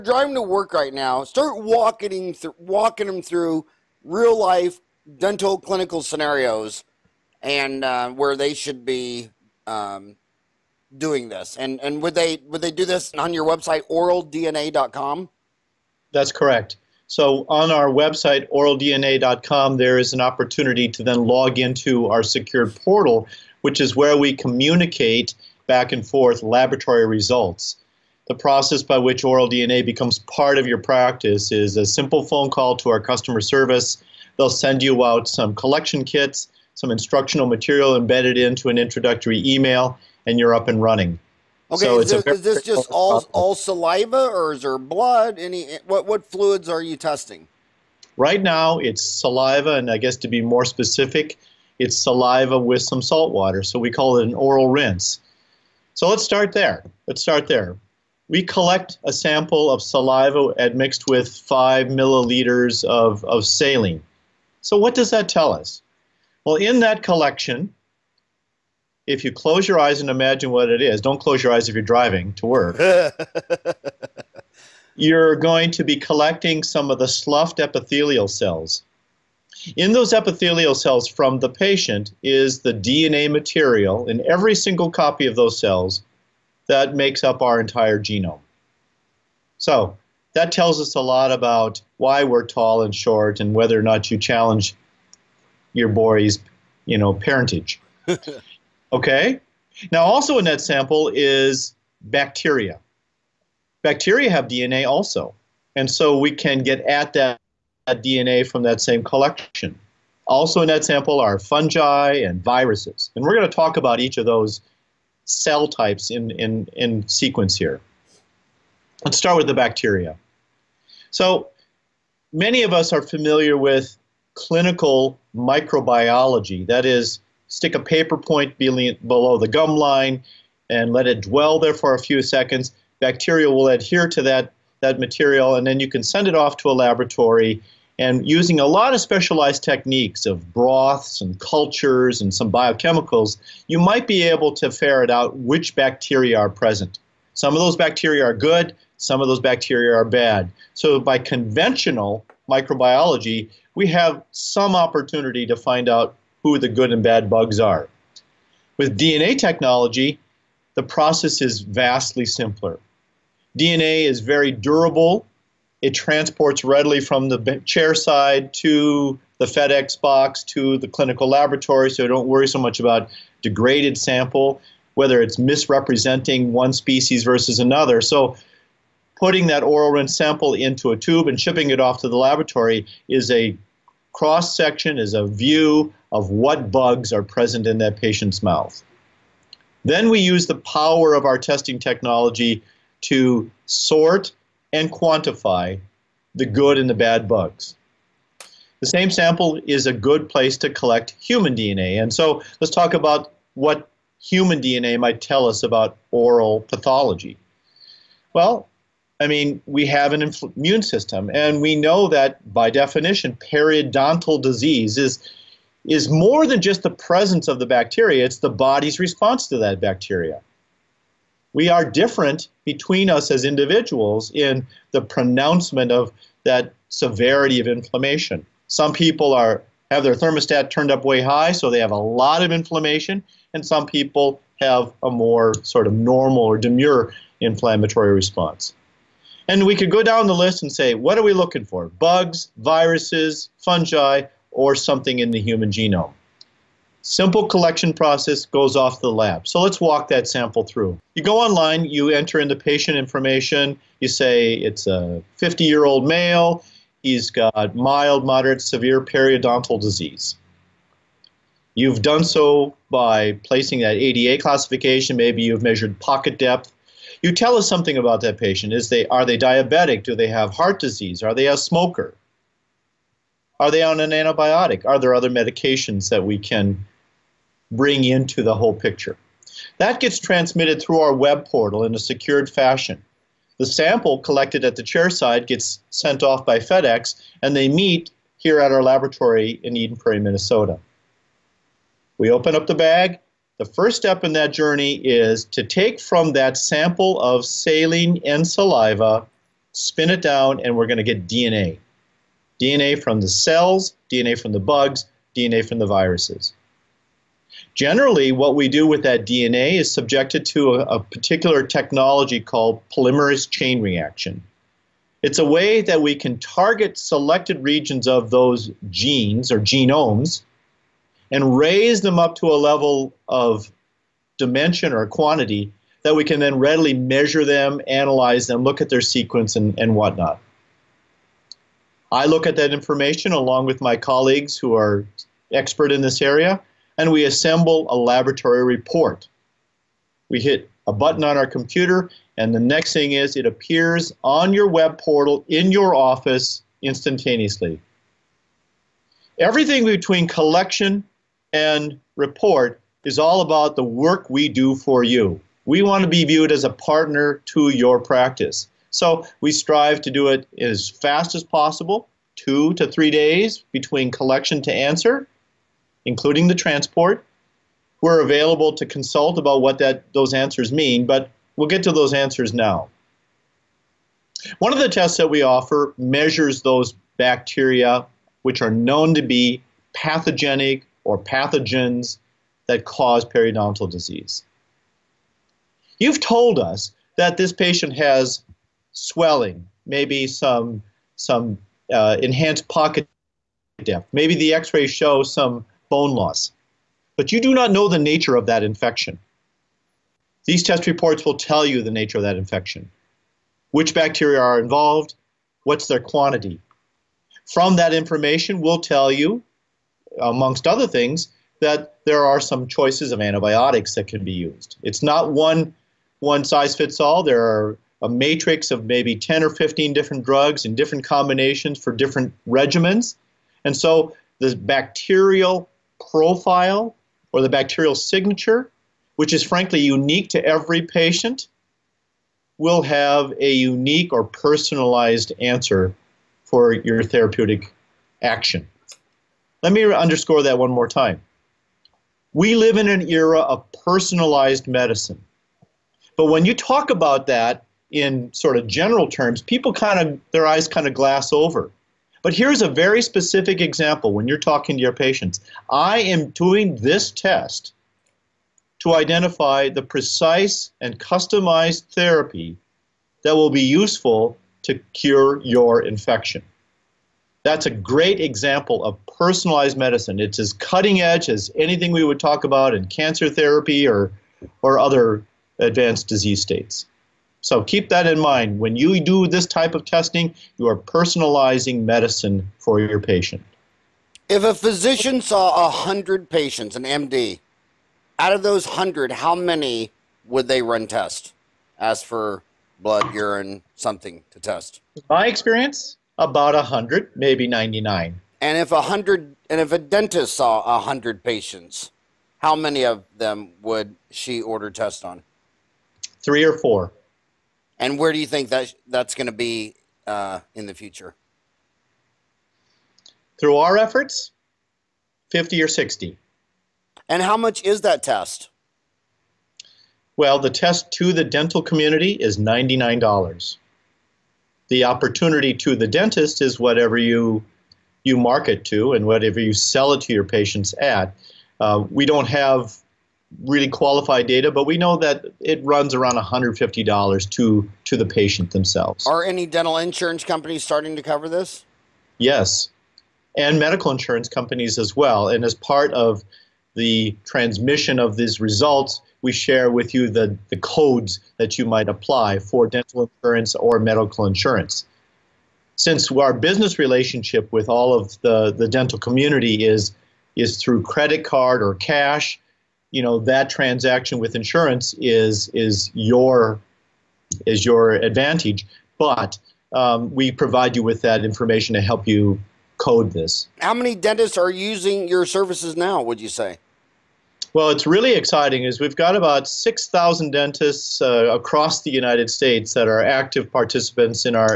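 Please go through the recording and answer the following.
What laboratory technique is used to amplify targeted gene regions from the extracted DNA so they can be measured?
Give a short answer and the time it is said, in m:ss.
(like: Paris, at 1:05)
polymerase chain reaction, at 5:12.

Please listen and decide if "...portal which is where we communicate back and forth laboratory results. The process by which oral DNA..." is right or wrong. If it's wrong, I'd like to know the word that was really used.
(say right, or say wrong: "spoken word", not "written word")
right.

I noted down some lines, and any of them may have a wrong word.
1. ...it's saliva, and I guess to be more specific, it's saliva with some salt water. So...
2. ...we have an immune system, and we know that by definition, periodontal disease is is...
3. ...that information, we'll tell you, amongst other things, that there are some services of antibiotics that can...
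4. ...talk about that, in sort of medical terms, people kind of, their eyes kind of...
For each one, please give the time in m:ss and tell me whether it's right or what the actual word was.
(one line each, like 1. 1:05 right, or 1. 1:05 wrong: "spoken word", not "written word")
1. 0:48 right
2. 3:29 right
3. 6:47 wrong: "choices", not "services"
4. 7:26 wrong: "general", not "medical".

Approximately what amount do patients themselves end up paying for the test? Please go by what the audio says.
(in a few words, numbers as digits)
$150.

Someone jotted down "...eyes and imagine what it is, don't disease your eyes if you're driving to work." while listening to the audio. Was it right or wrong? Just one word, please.
wrong.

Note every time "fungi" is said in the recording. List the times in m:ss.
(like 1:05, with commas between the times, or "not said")
1:51, 4:03.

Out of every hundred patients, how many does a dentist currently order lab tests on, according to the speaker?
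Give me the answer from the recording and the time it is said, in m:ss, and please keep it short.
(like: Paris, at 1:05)
3 or 4, at 8:26.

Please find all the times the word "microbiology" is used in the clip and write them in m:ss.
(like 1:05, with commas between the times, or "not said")
2:05, 2:32.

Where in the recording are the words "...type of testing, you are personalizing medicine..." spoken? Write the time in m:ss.
7:59.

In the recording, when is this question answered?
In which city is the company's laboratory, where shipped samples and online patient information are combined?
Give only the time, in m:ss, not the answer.
4:49.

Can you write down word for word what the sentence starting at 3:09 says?
Then we use the power of our testing technology to sort and quantify the good and the bad bugs.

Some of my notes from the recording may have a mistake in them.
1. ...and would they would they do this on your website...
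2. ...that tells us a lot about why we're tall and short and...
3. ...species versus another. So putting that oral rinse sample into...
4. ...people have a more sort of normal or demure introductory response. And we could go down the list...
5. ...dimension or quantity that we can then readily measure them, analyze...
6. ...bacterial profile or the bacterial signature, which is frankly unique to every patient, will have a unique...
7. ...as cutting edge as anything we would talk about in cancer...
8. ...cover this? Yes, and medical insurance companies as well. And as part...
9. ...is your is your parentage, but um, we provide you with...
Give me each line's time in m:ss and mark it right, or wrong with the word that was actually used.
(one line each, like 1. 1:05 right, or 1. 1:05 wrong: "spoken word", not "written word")
1. 0:11 right
2. 1:30 right
3. 2:56 right
4. 3:53 wrong: "inflammatory", not "introductory"
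5. 5:24 right
6. 7:04 right
7. 7:50 right
8. 9:01 right
9. 9:25 wrong: "advantage", not "parentage".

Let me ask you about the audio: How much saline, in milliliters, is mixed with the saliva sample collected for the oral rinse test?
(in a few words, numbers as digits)
5 milliliters.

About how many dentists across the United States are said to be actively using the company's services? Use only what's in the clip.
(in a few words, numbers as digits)
6,000.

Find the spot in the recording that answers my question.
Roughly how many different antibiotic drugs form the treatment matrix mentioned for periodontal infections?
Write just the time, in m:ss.
6:59.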